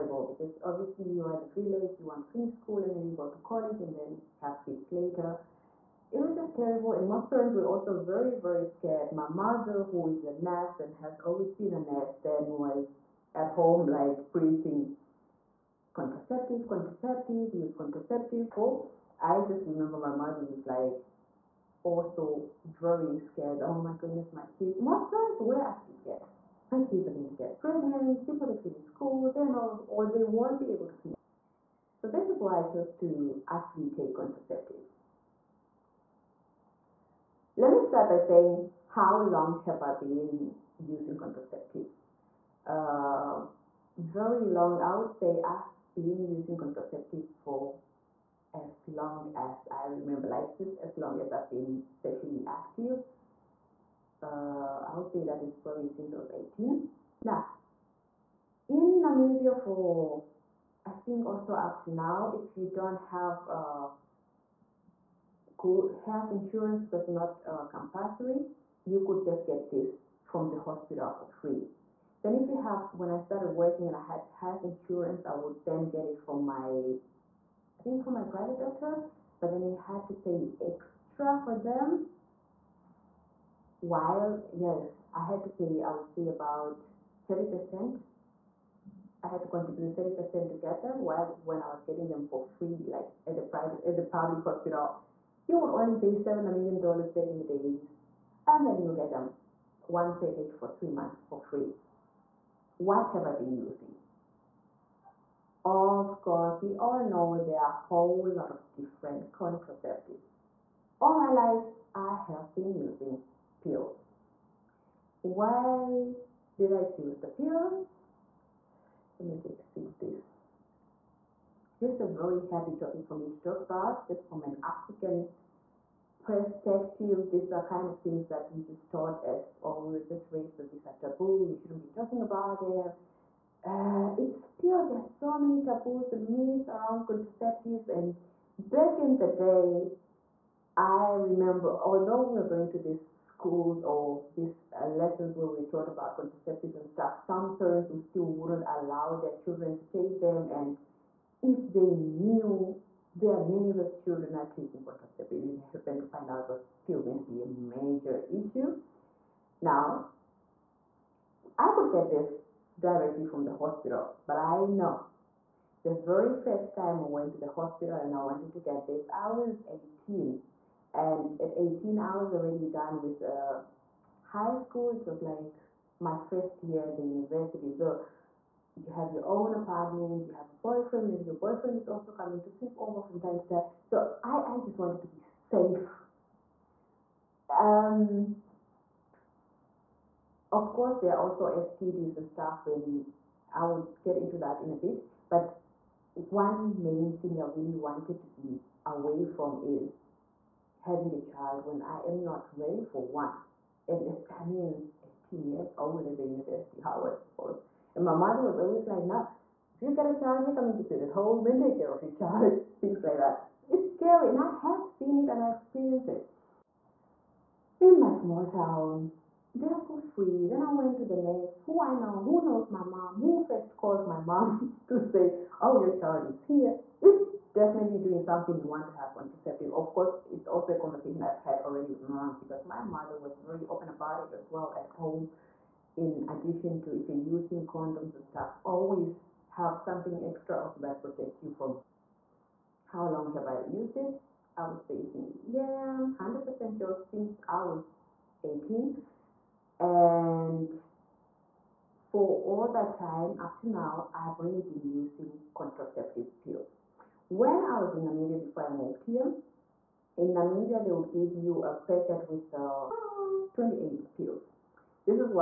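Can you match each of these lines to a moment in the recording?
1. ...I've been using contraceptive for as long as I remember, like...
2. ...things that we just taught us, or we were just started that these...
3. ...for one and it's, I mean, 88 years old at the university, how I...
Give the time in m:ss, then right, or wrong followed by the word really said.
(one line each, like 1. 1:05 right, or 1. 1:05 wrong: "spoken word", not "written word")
1. 0:45 right
2. 2:07 wrong: "raised", not "started"
3. 3:22 wrong: "18", not "88".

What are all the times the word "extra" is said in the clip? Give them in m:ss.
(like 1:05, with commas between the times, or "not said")
1:20, 4:00.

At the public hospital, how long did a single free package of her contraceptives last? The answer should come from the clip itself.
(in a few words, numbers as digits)
3 months.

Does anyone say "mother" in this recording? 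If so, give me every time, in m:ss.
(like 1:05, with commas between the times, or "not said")
0:09, 0:20, 3:28, 3:52.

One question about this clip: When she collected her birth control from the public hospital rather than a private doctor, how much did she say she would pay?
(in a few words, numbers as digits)
7 dollars.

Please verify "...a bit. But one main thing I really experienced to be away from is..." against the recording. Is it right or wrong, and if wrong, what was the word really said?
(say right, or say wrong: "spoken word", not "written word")
wrong: "wanted", not "experienced".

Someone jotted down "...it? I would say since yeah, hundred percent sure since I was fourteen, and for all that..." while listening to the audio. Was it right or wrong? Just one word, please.
wrong.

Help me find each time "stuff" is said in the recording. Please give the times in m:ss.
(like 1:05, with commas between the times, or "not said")
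2:26, 3:12, 3:58.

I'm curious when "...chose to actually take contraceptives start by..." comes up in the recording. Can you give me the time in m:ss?
0:32.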